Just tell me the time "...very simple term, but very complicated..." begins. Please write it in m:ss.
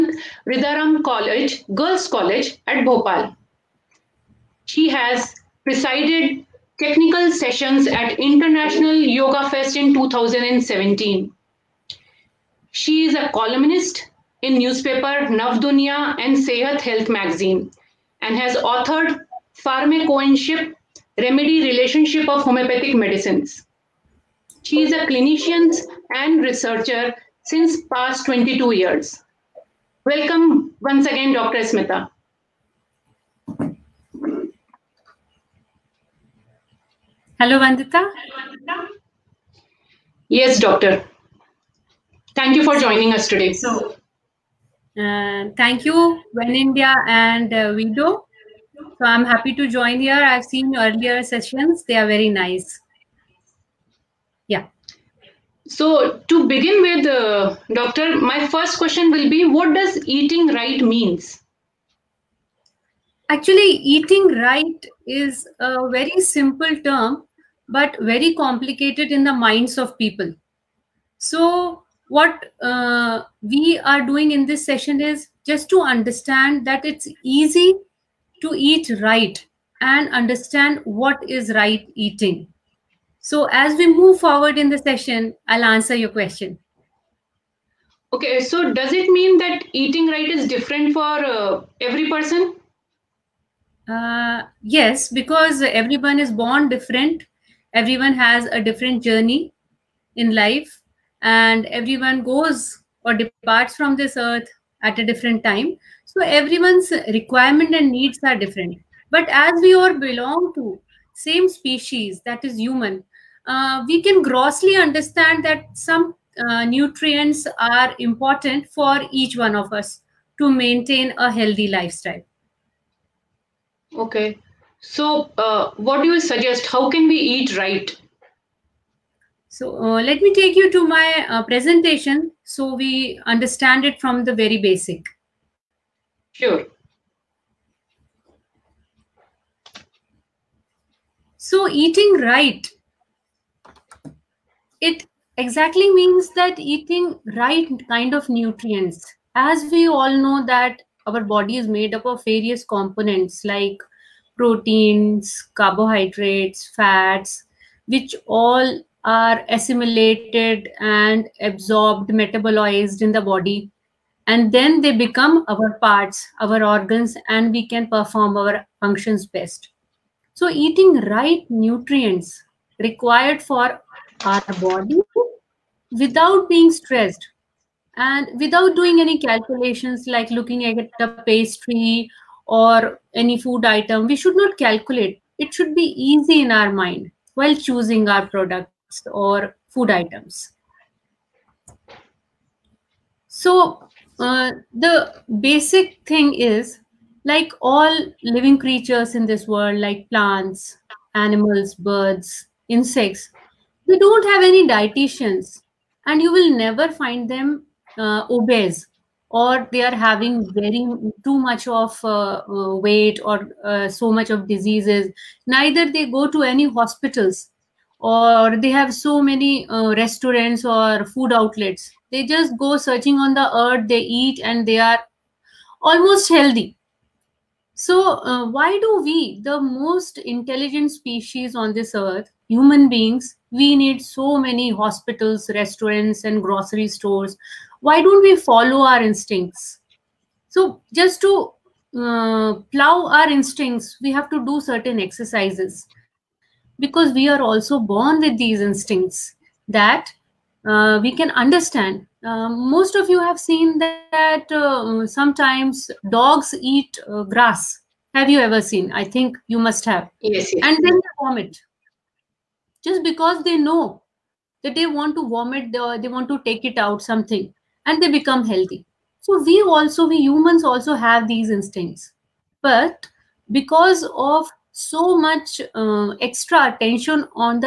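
1:05.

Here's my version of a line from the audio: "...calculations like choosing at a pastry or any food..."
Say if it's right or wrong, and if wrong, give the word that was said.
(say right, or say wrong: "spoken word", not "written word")
wrong: "looking", not "choosing".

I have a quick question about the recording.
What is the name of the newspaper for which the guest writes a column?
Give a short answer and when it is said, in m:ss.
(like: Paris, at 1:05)
Navdunya, at 0:15.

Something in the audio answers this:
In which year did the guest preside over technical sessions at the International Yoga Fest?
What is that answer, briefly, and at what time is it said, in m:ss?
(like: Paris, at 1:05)
2017, at 0:09.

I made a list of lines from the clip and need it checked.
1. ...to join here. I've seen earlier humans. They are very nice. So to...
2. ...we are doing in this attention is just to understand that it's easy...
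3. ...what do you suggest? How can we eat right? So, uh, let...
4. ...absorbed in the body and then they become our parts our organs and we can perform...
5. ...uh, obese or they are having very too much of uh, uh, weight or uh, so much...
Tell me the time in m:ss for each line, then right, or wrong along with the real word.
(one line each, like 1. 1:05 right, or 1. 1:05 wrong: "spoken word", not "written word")
1. 0:49 wrong: "sessions", not "humans"
2. 1:13 wrong: "session", not "attention"
3. 2:05 right
4. 2:42 wrong: "metabolized", not "absorbed"
5. 3:27 right.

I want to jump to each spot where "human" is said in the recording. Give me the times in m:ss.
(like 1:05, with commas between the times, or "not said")
1:52, 3:52, 4:30.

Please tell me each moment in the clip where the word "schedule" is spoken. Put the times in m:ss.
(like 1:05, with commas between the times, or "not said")
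not said.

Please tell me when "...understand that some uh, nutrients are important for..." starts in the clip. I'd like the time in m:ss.
1:54.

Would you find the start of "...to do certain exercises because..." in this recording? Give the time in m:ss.
4:04.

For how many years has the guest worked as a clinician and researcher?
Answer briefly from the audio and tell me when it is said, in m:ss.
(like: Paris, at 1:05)
22, at 0:28.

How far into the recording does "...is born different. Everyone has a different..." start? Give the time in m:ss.
1:36.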